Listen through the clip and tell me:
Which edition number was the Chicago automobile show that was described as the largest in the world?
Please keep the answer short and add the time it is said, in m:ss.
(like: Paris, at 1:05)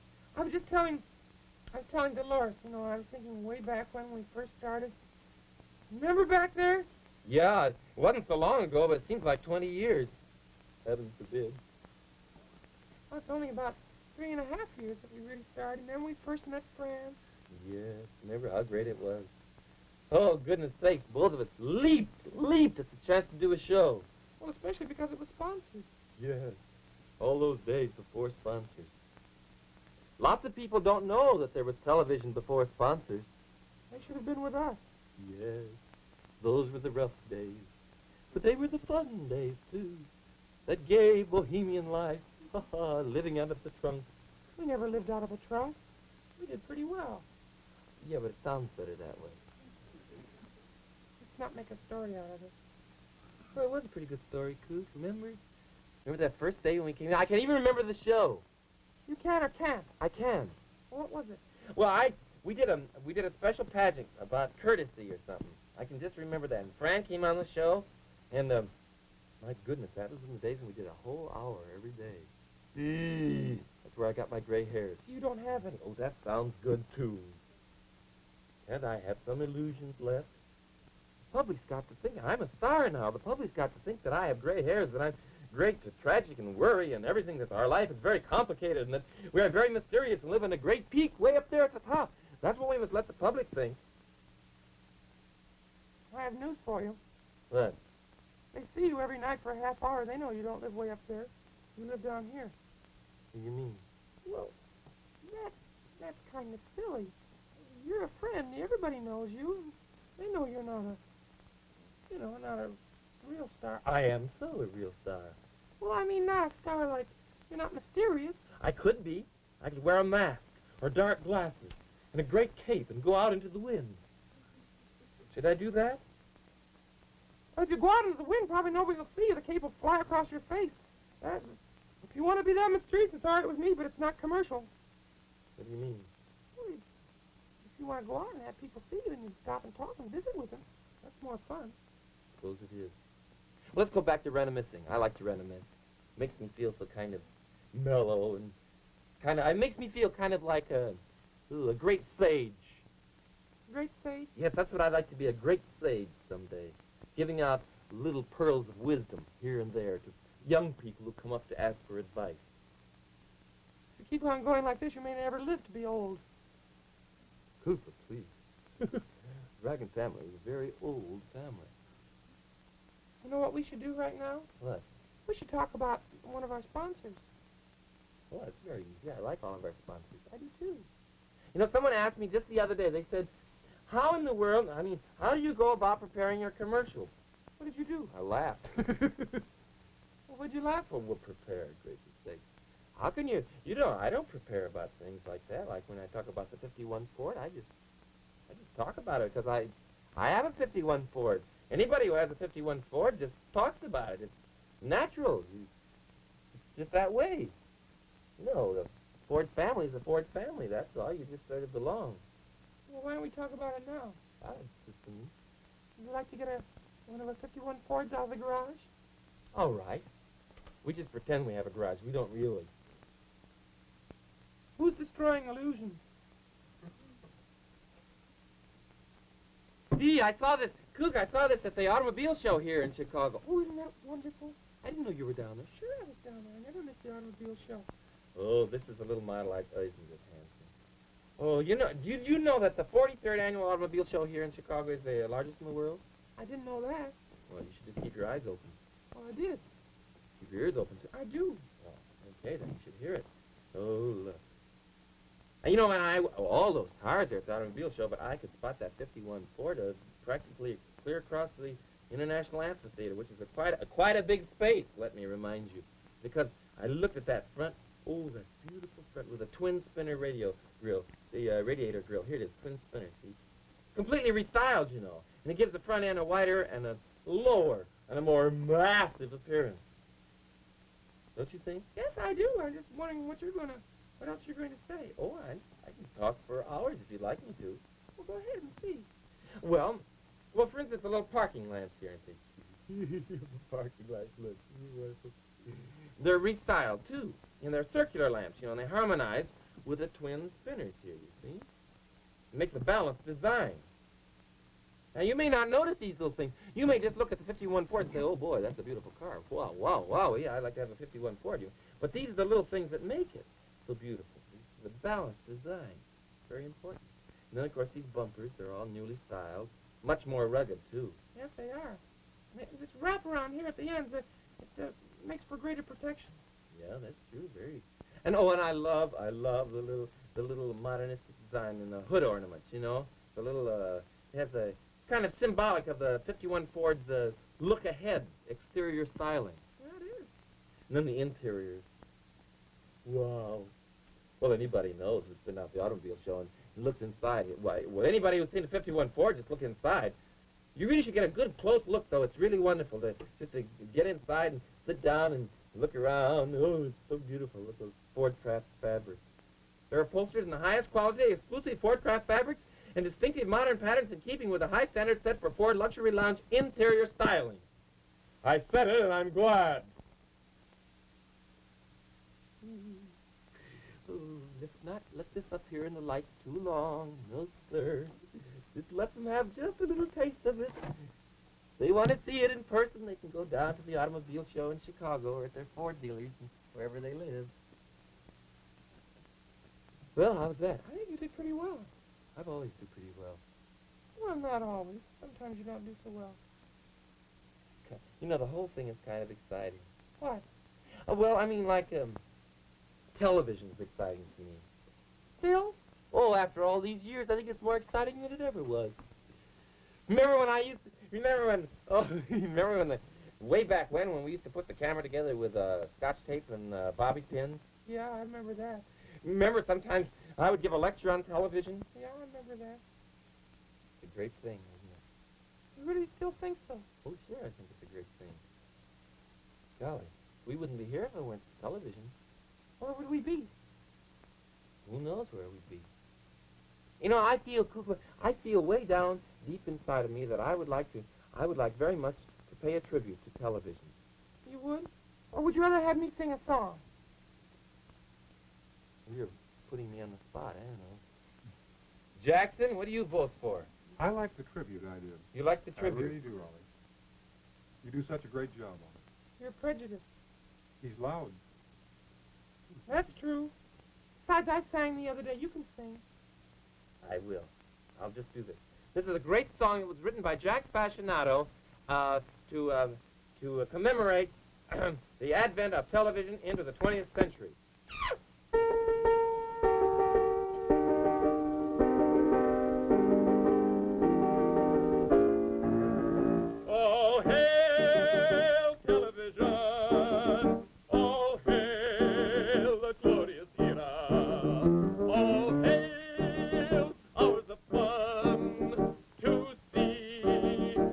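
43rd, at 4:02.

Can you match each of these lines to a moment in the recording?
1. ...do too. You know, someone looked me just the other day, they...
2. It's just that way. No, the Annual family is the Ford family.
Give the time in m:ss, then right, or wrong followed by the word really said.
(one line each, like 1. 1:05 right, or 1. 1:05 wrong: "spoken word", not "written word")
1. 3:00 wrong: "asked", not "looked"
2. 3:25 wrong: "Ford", not "Annual".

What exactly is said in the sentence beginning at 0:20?
Oh, goodness sakes, both of us leaped, leaped at the chance to do a show.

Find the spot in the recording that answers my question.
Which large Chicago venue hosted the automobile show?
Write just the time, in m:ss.
4:22.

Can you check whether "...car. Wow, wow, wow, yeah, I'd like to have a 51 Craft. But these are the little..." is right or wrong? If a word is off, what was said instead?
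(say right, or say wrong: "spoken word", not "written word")
wrong: "Ford", not "Craft".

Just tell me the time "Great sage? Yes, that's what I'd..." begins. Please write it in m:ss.
2:33.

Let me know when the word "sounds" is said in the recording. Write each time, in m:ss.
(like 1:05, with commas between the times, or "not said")
0:48, 1:16.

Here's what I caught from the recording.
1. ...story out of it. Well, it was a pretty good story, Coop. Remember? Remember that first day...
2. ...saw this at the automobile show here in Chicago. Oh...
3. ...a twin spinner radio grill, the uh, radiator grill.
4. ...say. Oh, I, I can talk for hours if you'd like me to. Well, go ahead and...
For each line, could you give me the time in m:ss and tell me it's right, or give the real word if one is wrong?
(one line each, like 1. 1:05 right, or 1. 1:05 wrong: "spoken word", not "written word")
1. 0:51 right
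2. 3:51 right
3. 4:29 right
4. 4:44 right.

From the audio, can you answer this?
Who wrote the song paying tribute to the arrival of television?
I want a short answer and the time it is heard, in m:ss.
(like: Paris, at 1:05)
Jack Fascinato, at 7:50.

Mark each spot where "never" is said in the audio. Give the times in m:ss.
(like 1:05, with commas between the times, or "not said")
0:44, 2:45, 3:56.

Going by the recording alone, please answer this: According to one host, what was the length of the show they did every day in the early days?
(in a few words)
a whole hour.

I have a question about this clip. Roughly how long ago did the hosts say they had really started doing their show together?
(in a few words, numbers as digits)
3 and a half years.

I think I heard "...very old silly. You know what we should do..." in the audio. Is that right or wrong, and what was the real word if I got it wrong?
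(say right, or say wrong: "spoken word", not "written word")
wrong: "family", not "silly".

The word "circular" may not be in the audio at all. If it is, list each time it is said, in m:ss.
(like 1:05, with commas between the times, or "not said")
4:57.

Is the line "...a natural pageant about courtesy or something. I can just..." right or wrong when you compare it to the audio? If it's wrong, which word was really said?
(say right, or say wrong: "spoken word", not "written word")
wrong: "special", not "natural".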